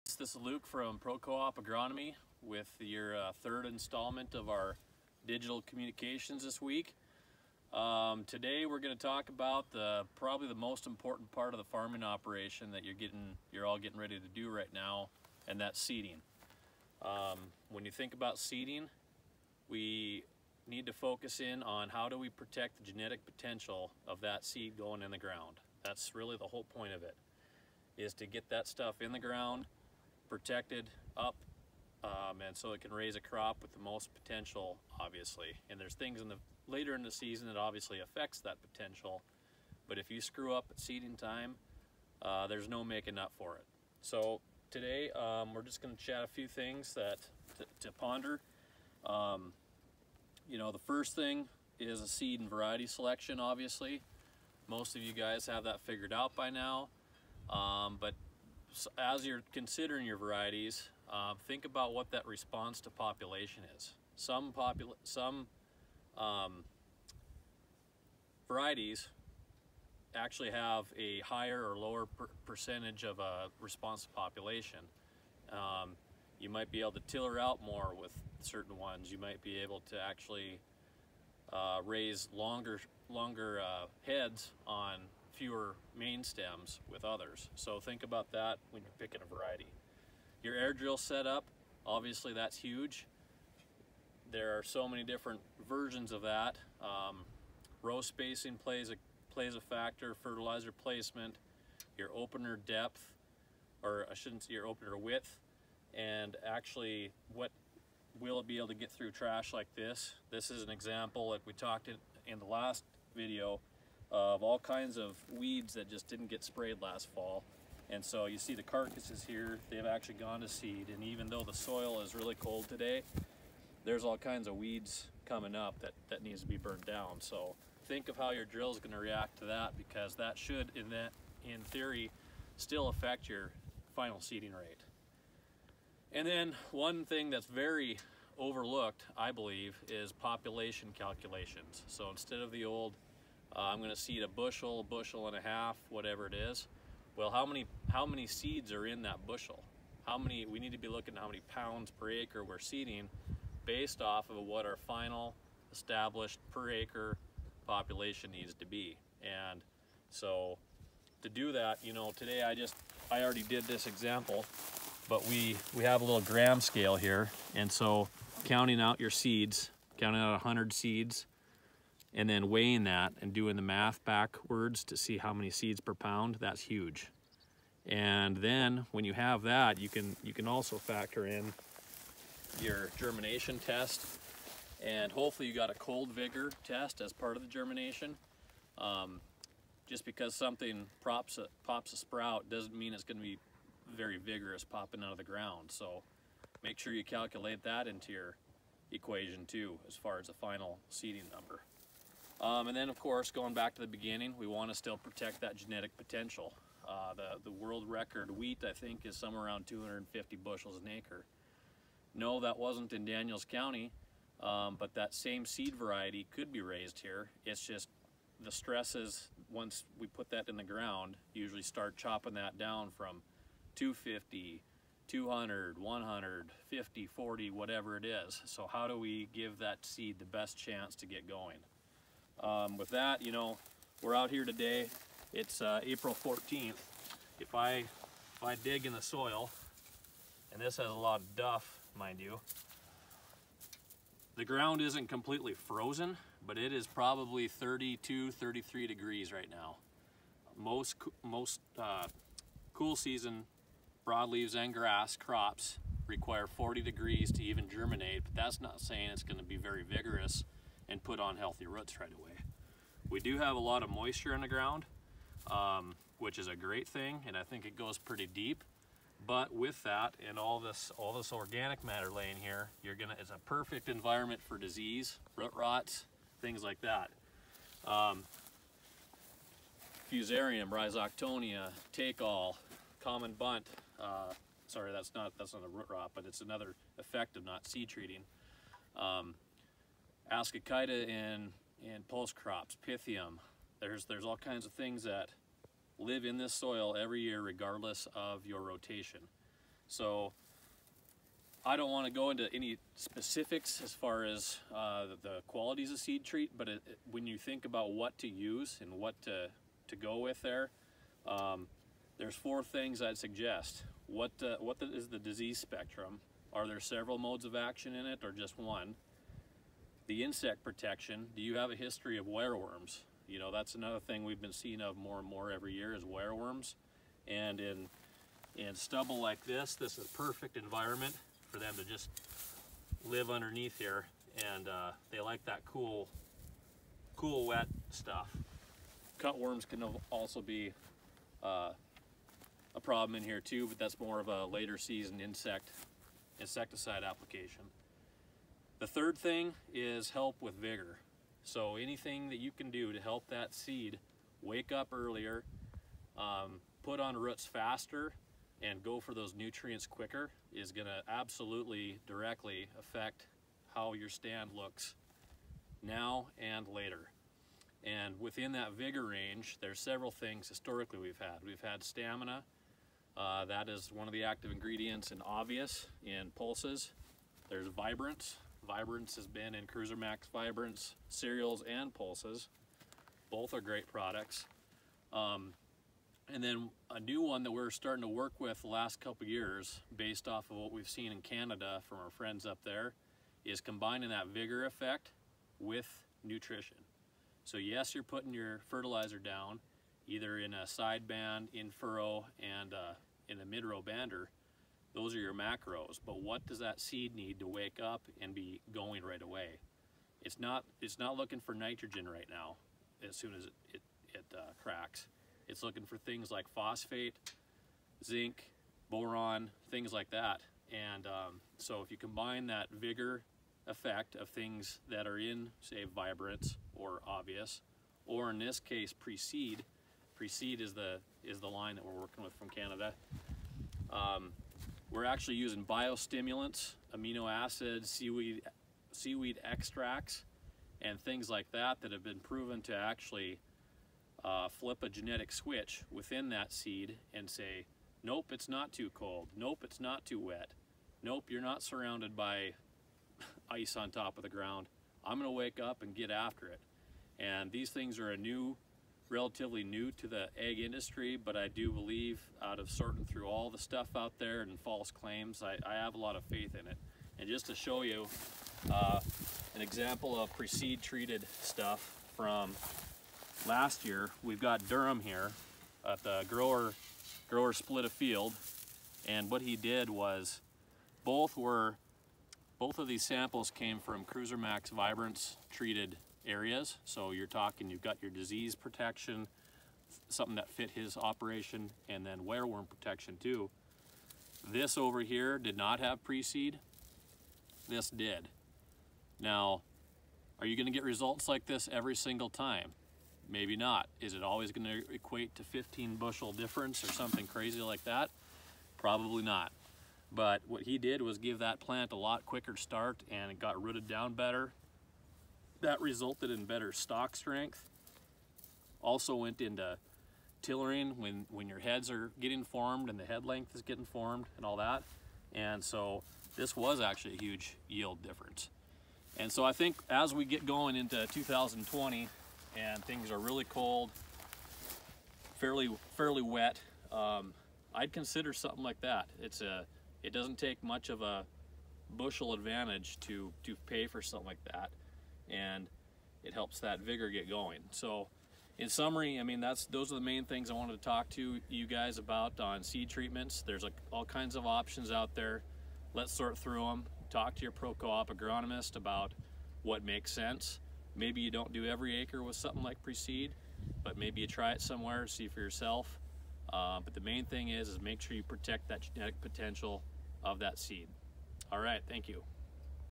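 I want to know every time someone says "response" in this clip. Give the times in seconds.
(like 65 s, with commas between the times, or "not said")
62 s, 73 s.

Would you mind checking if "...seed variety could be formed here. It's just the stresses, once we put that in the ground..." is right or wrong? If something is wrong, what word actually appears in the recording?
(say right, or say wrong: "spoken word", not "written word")
wrong: "raised", not "formed".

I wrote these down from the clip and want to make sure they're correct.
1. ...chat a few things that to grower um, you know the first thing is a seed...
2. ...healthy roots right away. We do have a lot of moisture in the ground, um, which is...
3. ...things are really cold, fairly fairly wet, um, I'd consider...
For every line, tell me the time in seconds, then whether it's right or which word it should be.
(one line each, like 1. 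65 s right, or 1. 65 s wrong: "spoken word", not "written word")
1. 46 s wrong: "ponder", not "grower"
2. 261 s right
3. 532 s right.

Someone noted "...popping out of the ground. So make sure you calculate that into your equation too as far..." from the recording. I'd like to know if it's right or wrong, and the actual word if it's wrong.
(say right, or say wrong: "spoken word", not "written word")
right.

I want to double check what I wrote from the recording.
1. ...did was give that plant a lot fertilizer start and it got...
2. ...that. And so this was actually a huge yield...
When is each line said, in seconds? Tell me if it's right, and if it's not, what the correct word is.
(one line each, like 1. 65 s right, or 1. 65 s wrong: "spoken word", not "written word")
1. 510 s wrong: "quicker", not "fertilizer"
2. 524 s right.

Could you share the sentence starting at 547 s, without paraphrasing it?
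So in summary, I mean, that's those are the main things I wanted to talk to you guys about on seed treatments.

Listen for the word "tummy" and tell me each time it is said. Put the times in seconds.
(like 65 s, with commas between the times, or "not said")
not said.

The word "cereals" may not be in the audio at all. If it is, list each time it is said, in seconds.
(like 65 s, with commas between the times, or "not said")
381 s.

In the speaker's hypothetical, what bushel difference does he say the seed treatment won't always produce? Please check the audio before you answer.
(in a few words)
15 bushels.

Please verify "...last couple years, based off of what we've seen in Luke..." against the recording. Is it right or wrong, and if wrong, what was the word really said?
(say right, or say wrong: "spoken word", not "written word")
wrong: "Canada", not "Luke".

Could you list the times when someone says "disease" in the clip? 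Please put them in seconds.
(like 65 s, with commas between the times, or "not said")
274 s, 315 s, 488 s.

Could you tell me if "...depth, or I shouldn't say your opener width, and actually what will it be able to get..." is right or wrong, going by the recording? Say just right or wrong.
right.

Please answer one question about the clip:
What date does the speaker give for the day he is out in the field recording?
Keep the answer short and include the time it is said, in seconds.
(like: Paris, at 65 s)
April 14th, at 235 s.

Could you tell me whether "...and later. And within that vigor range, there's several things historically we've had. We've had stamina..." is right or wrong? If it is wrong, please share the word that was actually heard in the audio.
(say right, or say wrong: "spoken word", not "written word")
right.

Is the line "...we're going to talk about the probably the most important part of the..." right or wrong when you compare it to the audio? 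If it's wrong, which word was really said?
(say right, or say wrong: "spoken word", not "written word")
right.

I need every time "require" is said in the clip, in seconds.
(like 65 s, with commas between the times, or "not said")
256 s.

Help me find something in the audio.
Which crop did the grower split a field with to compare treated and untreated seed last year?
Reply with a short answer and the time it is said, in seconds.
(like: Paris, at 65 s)
Durum, at 474 s.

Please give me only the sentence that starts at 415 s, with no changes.
It's looking for things like phosphate, zinc, boron, things like that.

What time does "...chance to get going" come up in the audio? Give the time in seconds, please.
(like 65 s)
230 s.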